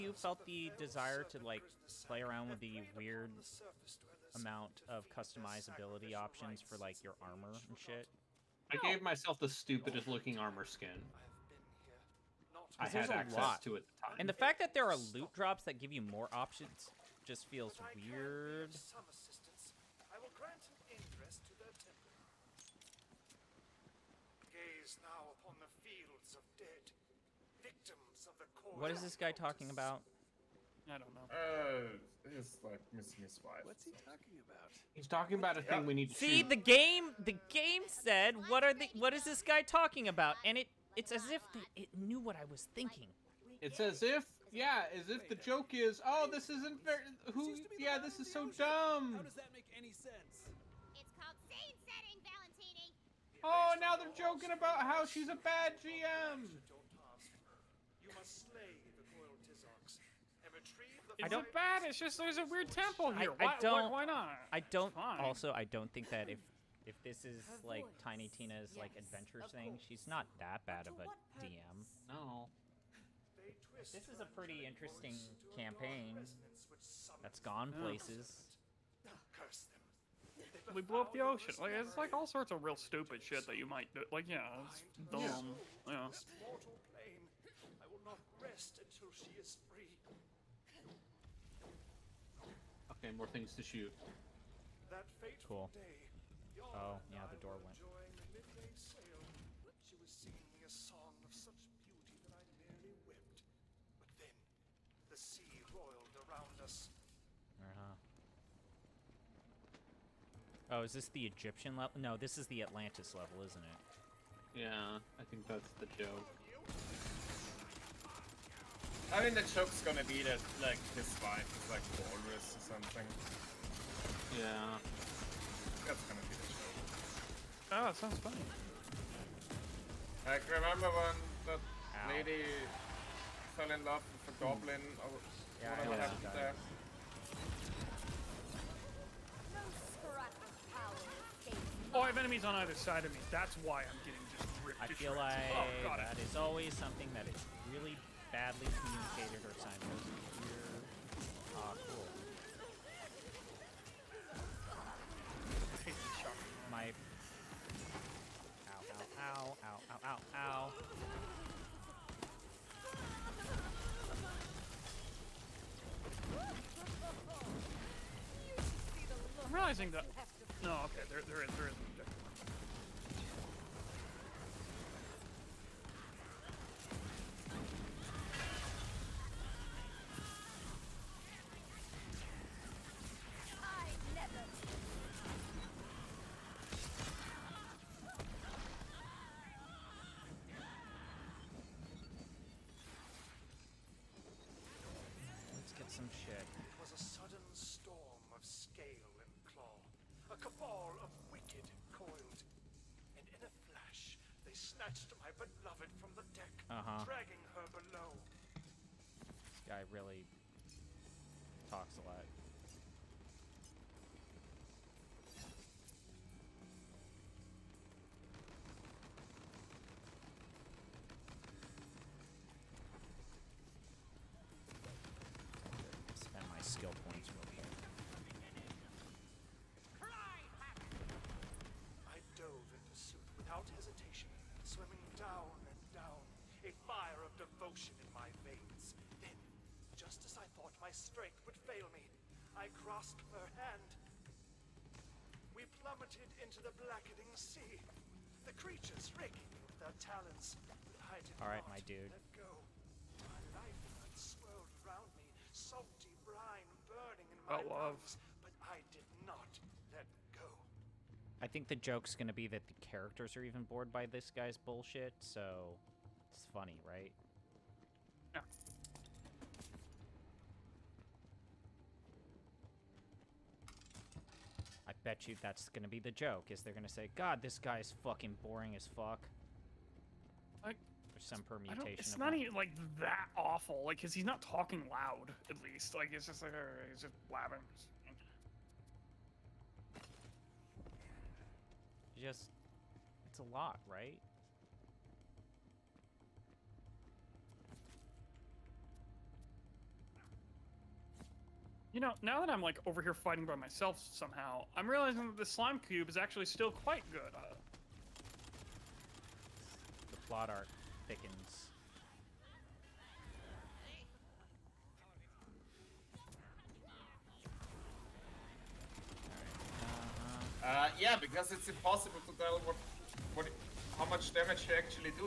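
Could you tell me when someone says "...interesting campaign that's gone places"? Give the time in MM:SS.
01:14.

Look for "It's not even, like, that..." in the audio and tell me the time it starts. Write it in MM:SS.
04:41.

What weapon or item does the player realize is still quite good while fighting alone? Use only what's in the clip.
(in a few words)
Slime cube.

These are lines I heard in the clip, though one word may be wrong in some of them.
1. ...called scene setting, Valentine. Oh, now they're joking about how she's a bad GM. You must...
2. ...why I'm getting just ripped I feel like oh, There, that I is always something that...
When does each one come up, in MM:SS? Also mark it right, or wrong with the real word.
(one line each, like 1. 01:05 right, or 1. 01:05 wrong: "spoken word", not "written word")
1. 00:51 right
2. 02:23 wrong: "God", not "There".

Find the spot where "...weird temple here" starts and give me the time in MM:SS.
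01:02.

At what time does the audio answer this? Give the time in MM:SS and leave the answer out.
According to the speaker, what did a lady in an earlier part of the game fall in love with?
02:14.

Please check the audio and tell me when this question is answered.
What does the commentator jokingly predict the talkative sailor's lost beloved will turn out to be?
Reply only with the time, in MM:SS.
02:02.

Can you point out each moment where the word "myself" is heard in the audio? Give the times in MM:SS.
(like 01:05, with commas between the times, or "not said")
00:09, 05:03.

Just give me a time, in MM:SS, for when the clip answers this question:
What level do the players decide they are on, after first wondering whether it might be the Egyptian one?
01:52.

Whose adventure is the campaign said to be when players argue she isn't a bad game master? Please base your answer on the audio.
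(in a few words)
Tiny Tina.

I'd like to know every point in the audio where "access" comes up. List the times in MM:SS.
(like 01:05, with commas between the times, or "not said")
00:13.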